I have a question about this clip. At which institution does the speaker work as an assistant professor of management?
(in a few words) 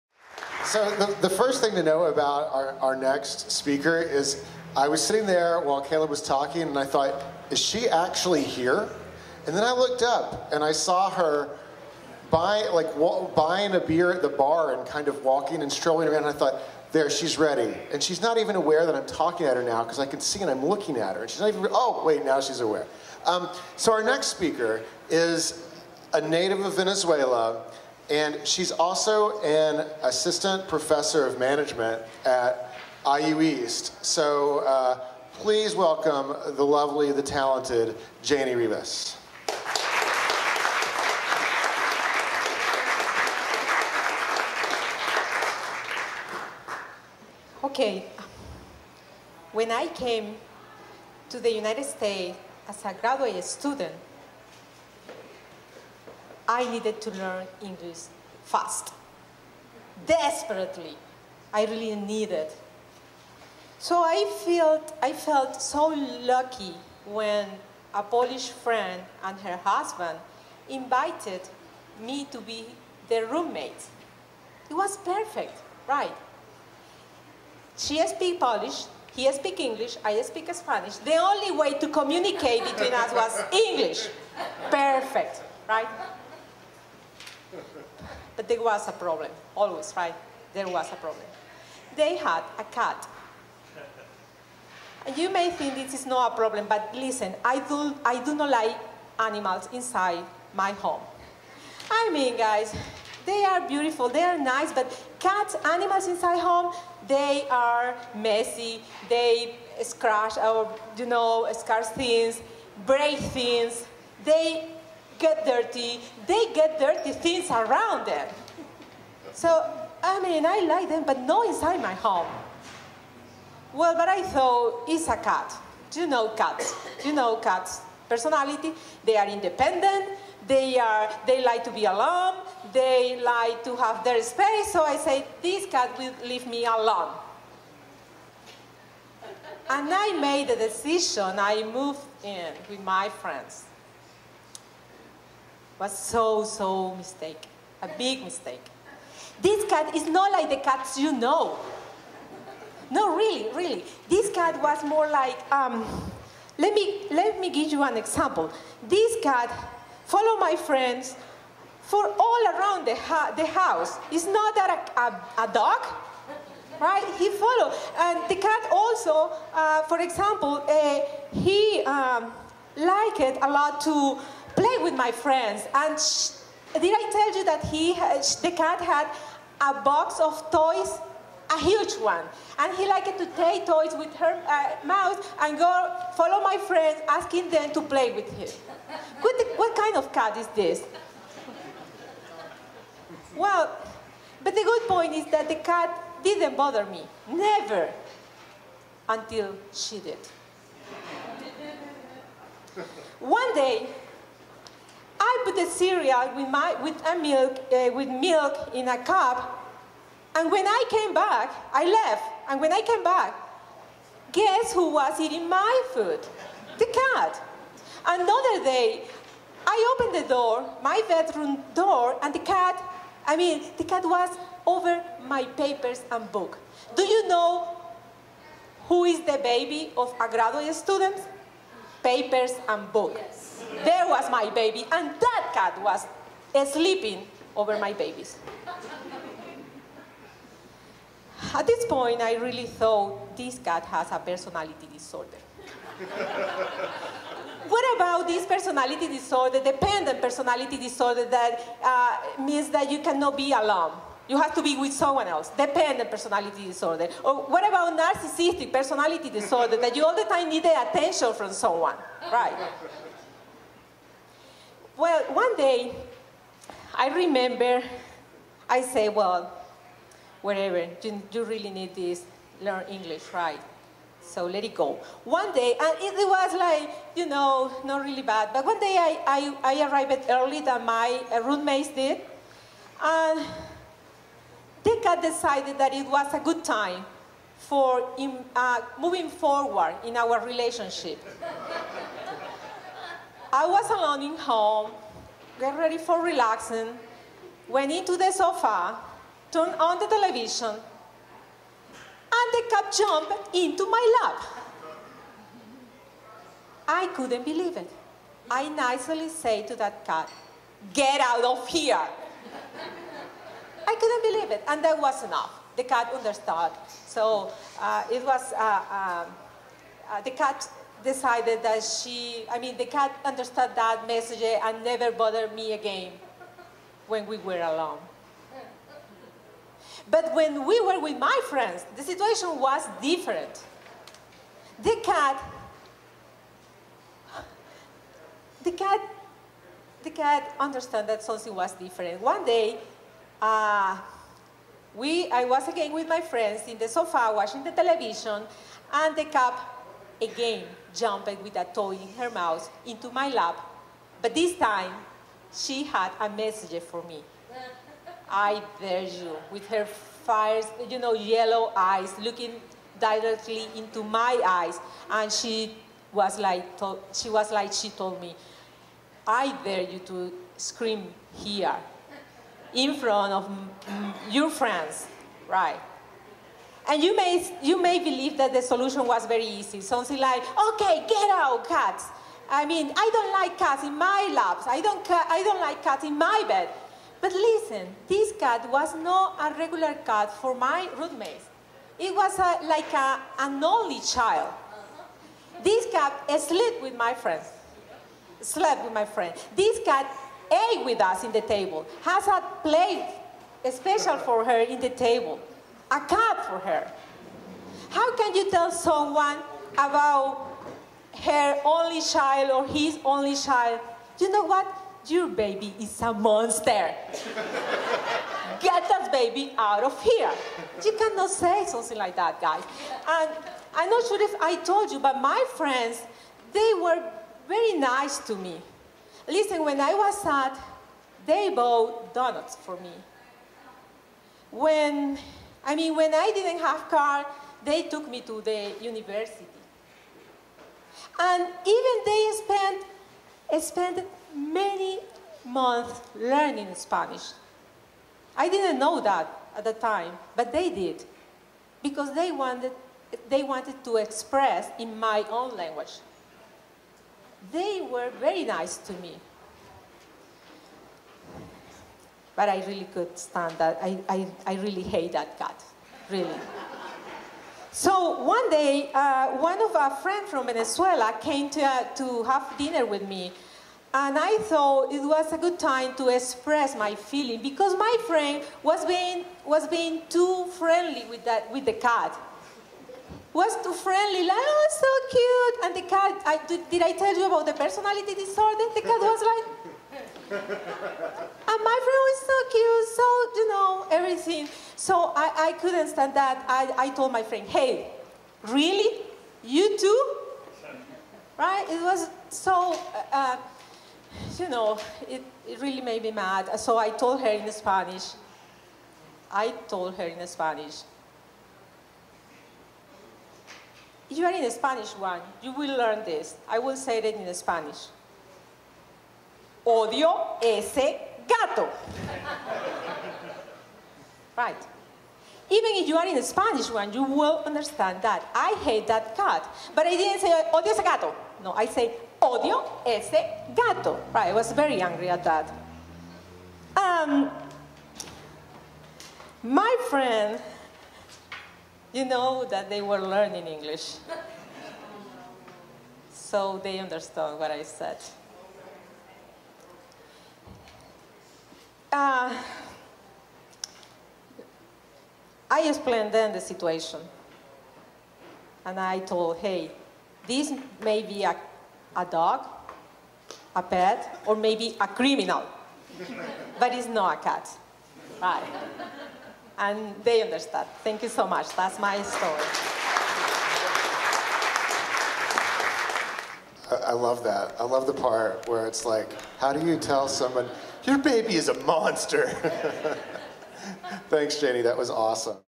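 IU East.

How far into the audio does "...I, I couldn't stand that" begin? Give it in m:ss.
8:15.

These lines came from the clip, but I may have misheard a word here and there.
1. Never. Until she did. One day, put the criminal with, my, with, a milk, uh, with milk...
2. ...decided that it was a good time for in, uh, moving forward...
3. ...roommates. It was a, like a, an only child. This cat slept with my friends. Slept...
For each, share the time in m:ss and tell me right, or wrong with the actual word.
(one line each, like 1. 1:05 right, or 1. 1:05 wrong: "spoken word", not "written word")
1. 3:17 wrong: "cereal", not "criminal"
2. 4:45 right
3. 6:30 right.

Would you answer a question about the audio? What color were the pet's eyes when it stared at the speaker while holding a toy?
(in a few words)
Yellow.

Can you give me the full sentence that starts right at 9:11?
Uh, I explained then the situation.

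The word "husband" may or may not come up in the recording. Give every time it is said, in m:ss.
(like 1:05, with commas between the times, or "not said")
1:09.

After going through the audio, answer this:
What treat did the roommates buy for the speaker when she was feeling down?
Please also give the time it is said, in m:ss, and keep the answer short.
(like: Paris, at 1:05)
Donuts, at 7:12.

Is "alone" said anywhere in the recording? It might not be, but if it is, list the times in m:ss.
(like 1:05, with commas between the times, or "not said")
2:11, 2:16, 4:13, 4:53, 5:27.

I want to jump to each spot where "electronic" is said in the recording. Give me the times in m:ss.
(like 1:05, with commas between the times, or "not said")
not said.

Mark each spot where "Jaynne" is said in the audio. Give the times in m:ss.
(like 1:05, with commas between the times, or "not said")
0:38, 9:44.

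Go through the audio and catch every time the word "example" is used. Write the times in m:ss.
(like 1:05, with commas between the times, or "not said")
2:37, 2:49.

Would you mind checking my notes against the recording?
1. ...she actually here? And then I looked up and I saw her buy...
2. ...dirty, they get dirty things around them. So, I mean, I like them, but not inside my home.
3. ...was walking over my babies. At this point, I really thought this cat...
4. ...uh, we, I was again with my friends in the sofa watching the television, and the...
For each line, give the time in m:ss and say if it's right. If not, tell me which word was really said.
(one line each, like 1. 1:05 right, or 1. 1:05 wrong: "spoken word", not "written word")
1. 0:07 right
2. 1:55 right
3. 3:55 wrong: "sleeping", not "walking"
4. 5:43 right.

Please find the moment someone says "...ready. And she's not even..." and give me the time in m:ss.
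0:17.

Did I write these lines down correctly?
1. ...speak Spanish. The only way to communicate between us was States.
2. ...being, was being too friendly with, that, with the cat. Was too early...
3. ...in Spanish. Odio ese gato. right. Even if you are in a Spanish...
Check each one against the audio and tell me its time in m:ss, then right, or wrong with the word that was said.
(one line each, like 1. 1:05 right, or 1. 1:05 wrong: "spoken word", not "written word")
1. 1:20 wrong: "English", not "States"
2. 7:58 wrong: "friendly", not "early"
3. 8:37 right.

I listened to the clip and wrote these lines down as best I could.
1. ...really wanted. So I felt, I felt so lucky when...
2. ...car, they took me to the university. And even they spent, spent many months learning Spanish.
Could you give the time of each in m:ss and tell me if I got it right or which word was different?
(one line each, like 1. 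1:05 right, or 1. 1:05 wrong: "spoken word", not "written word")
1. 1:01 wrong: "needed", not "wanted"
2. 7:16 right.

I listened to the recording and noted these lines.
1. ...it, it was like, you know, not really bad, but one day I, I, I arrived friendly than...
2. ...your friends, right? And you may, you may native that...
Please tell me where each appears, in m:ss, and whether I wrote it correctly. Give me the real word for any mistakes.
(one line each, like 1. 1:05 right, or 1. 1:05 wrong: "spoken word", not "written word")
1. 4:35 wrong: "early", not "friendly"
2. 6:14 wrong: "believe", not "native".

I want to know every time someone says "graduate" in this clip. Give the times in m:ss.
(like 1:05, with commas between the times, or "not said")
0:52, 3:50.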